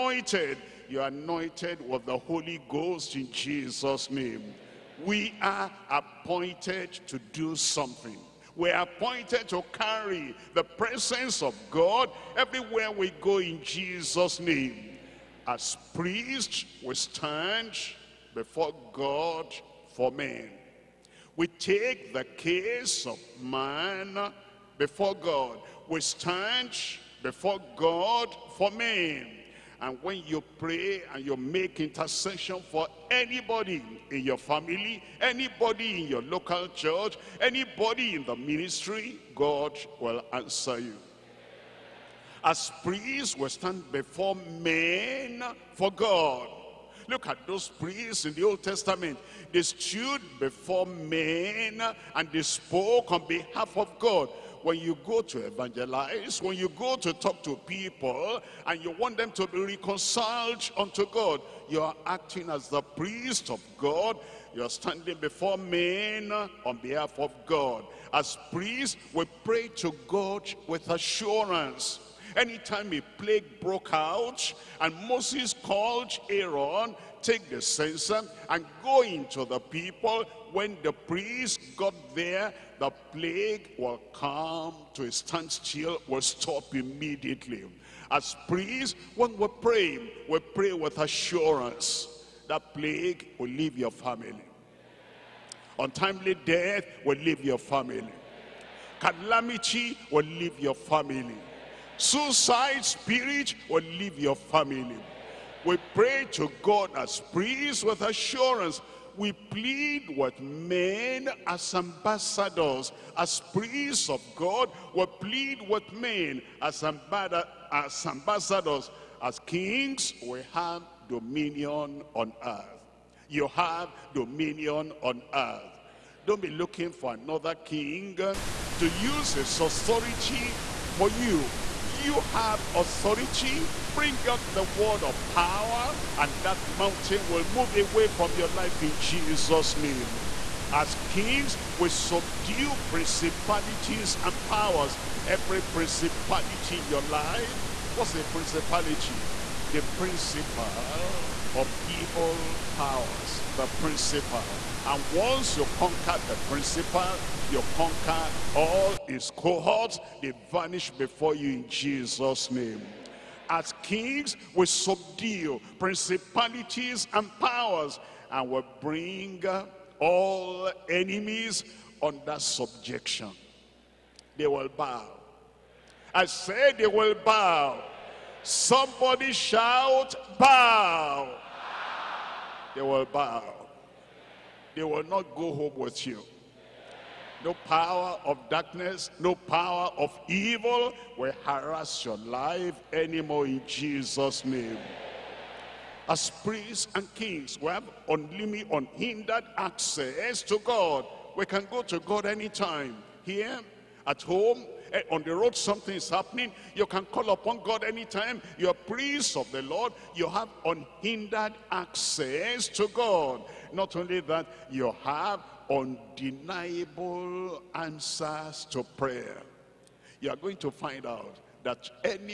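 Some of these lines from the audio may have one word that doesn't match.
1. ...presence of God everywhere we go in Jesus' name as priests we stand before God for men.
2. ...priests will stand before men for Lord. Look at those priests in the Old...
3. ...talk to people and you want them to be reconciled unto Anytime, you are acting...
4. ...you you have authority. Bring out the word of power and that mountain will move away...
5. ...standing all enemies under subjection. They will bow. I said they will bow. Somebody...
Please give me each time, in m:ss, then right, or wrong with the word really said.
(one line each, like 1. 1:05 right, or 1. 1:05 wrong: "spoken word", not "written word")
1. 0:10 right
2. 0:42 wrong: "God", not "Lord"
3. 0:57 wrong: "God", not "Anytime"
4. 2:11 right
5. 2:48 wrong: "bring", not "standing".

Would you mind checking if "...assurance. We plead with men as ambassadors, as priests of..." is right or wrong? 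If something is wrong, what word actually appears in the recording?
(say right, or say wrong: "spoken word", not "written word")
right.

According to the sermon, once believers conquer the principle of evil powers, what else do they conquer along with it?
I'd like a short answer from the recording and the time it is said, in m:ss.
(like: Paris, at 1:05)
all his cohorts, at 2:38.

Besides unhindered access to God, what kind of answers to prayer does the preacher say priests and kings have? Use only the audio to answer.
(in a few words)
undeniable.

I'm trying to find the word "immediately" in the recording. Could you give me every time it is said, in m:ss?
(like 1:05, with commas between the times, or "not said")
1:26.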